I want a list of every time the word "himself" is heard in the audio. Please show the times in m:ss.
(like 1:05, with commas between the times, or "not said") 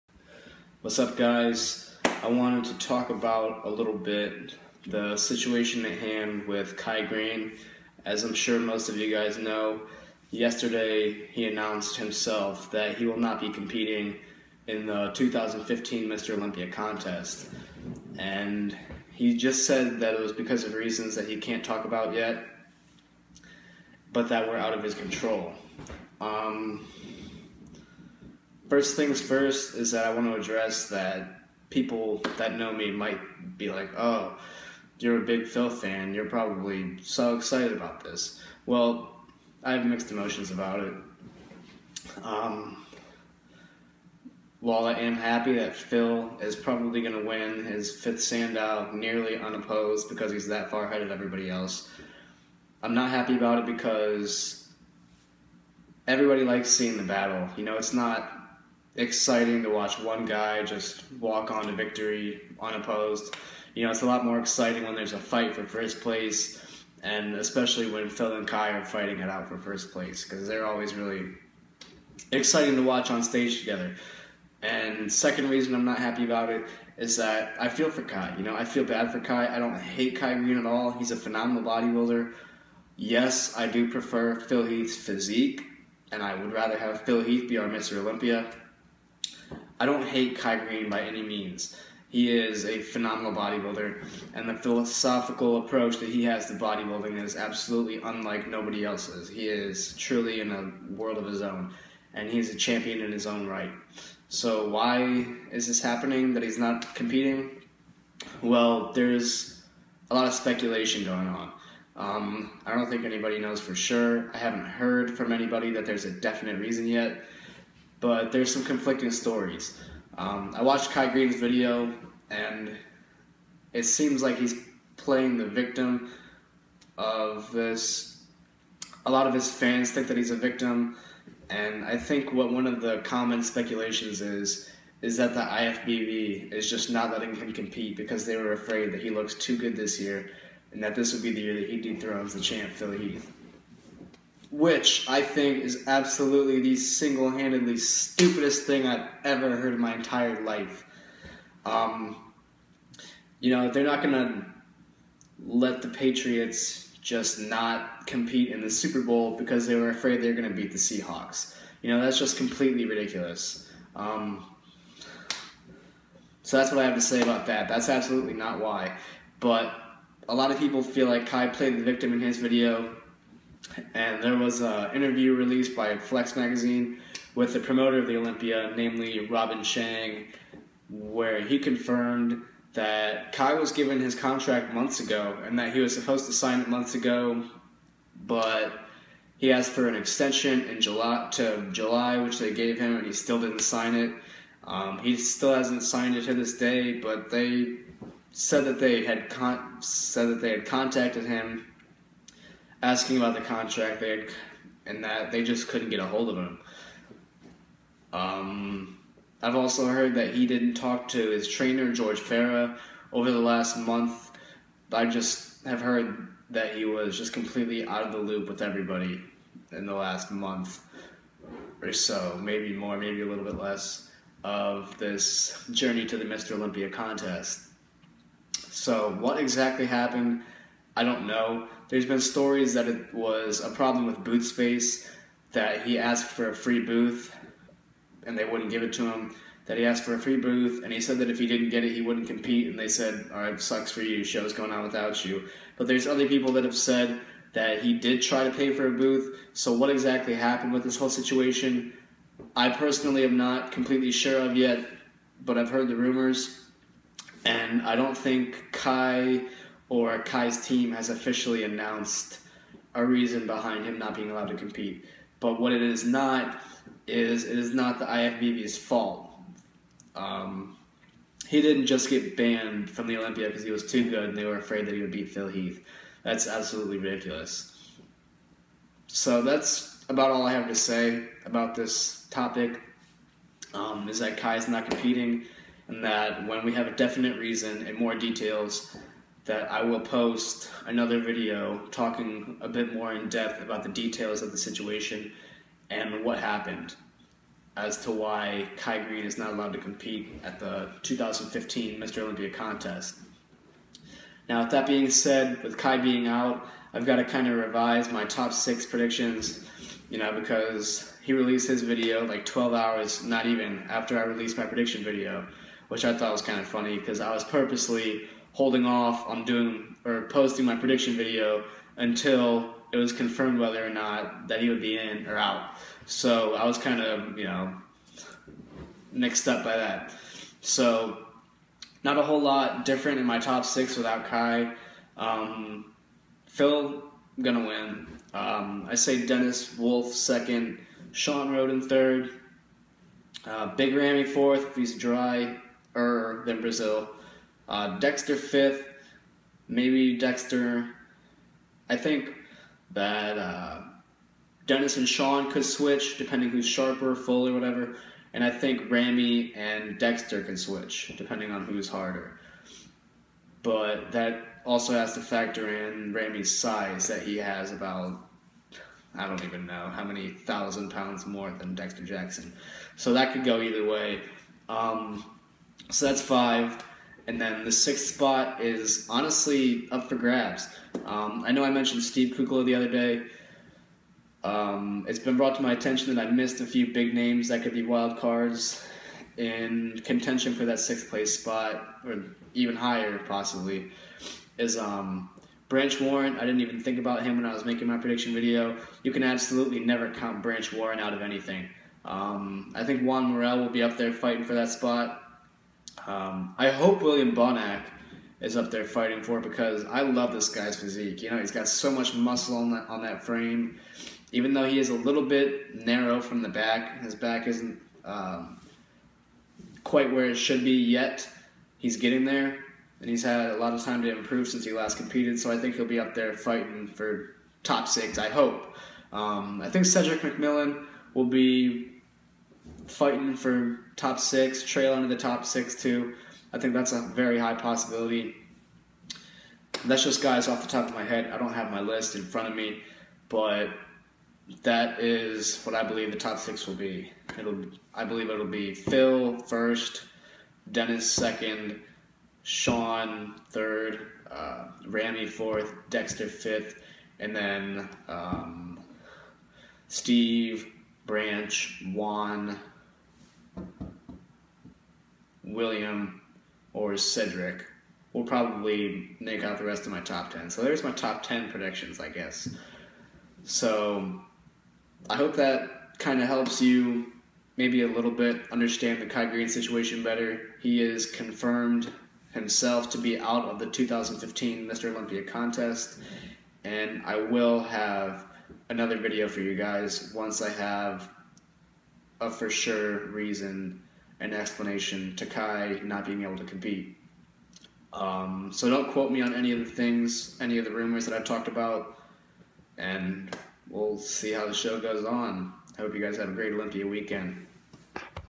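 0:11, 8:02.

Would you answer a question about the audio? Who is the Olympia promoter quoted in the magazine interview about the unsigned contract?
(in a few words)
Robin Chang.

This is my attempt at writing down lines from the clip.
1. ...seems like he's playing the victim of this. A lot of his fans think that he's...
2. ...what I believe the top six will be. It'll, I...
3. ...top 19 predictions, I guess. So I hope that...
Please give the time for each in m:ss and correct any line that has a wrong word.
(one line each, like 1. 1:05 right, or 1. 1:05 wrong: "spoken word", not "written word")
1. 2:03 right
2. 7:25 right
3. 7:50 wrong: "10", not "19".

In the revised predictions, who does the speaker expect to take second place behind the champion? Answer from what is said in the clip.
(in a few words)
Dennis Wolf.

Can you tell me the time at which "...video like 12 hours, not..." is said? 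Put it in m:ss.
5:11.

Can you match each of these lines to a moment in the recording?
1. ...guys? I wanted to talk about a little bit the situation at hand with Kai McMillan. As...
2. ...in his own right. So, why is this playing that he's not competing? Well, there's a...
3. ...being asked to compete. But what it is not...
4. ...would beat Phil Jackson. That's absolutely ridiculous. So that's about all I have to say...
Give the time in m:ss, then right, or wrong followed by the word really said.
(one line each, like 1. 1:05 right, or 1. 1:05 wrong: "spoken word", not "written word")
1. 0:01 wrong: "Greene", not "McMillan"
2. 1:43 wrong: "happening", not "playing"
3. 4:24 wrong: "allowed", not "asked"
4. 4:35 wrong: "Heath", not "Jackson".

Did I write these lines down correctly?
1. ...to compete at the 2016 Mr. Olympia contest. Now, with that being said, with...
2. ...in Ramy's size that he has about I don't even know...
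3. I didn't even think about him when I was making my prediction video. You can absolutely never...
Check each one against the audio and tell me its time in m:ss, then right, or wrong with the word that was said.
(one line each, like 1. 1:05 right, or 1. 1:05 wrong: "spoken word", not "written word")
1. 4:59 wrong: "2015", not "2016"
2. 6:05 right
3. 6:36 right.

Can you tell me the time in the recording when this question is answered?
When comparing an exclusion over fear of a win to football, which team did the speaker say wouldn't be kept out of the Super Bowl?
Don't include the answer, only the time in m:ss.
2:35.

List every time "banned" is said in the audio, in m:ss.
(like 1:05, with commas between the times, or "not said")
4:32.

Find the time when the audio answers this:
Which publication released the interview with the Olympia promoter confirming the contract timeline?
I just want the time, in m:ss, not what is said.
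2:55.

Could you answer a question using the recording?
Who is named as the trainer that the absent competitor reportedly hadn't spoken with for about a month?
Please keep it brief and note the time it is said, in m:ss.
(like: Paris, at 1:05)
George Farah, at 3:31.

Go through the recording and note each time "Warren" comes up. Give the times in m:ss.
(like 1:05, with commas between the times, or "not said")
6:36, 6:40.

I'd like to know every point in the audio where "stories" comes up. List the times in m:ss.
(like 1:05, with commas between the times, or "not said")
1:59, 3:52.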